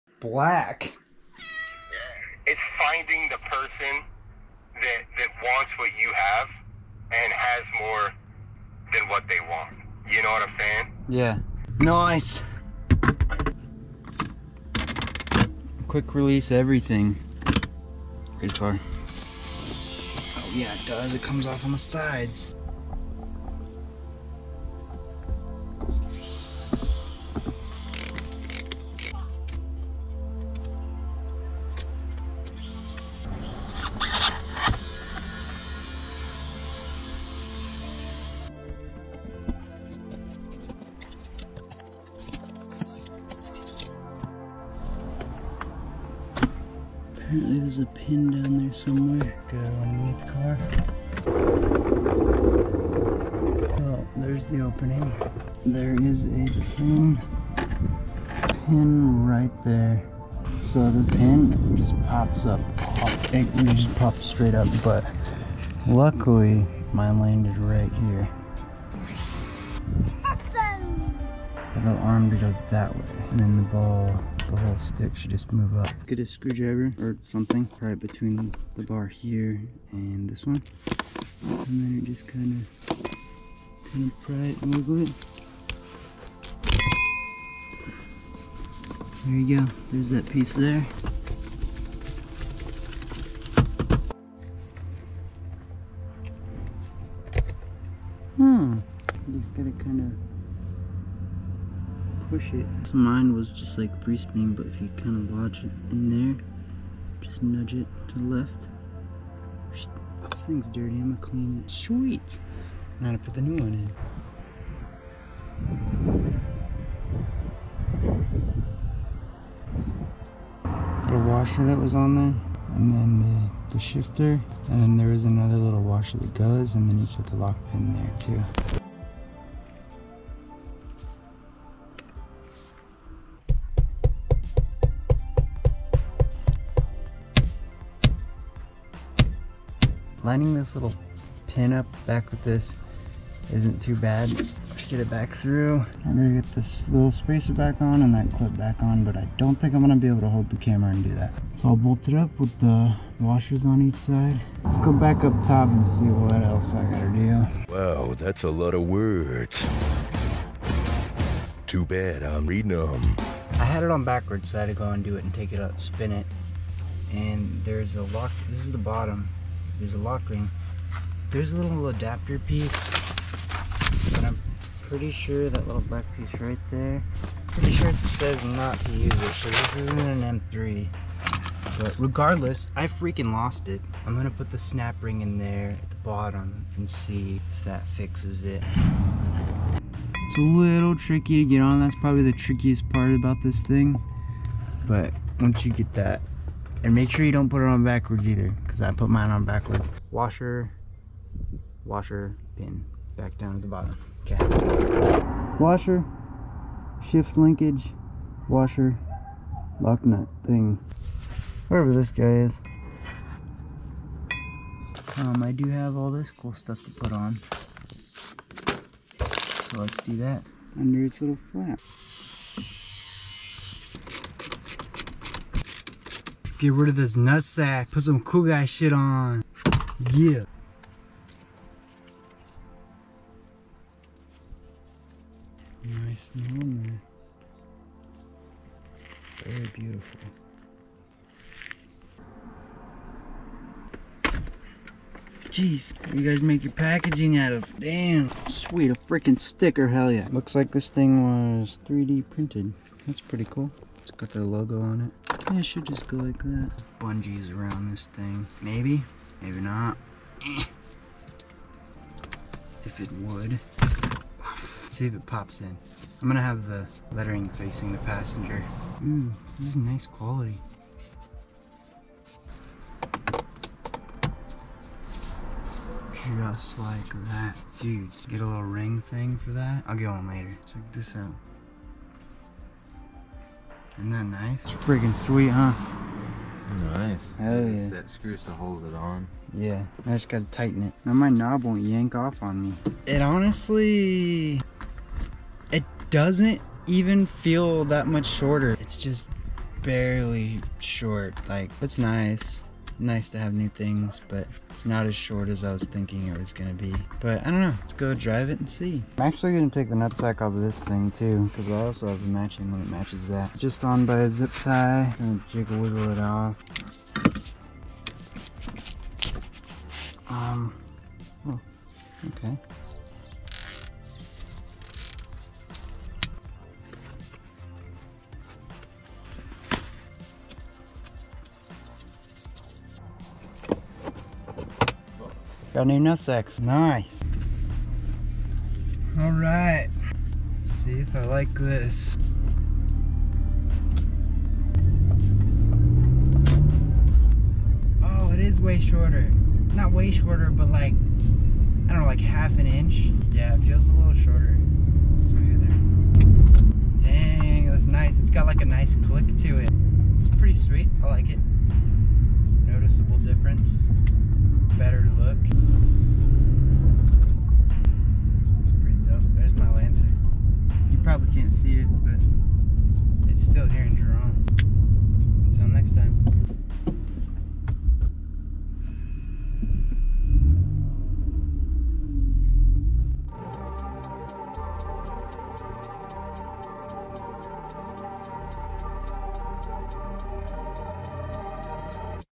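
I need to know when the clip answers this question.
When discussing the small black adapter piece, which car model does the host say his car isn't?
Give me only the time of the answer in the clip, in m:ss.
3:00.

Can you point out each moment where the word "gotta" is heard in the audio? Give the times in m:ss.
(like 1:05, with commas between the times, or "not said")
1:39, 2:36, 4:50.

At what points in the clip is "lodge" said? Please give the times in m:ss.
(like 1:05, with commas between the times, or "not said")
1:45.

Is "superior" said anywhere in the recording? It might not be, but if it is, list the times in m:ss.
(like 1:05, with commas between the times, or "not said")
not said.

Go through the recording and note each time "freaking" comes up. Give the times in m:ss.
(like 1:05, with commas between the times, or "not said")
3:02, 4:08.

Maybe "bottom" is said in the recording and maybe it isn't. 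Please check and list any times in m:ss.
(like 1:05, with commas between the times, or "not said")
2:48, 3:05, 3:23.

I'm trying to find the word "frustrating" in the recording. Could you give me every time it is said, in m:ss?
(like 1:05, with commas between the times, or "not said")
not said.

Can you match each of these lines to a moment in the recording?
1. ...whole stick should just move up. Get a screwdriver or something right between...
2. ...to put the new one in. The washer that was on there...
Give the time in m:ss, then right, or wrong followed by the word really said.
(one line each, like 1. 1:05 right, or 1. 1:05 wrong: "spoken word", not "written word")
1. 1:14 right
2. 1:53 right.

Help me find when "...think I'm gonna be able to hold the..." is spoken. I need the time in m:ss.
2:29.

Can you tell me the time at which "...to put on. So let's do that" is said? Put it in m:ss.
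3:36.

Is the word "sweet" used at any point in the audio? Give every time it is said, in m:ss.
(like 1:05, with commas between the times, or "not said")
1:51, 4:08, 4:45, 6:00.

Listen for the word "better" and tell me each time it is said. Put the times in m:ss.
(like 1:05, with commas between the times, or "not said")
6:04.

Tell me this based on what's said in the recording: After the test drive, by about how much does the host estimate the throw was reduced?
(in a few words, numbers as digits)
half an inch.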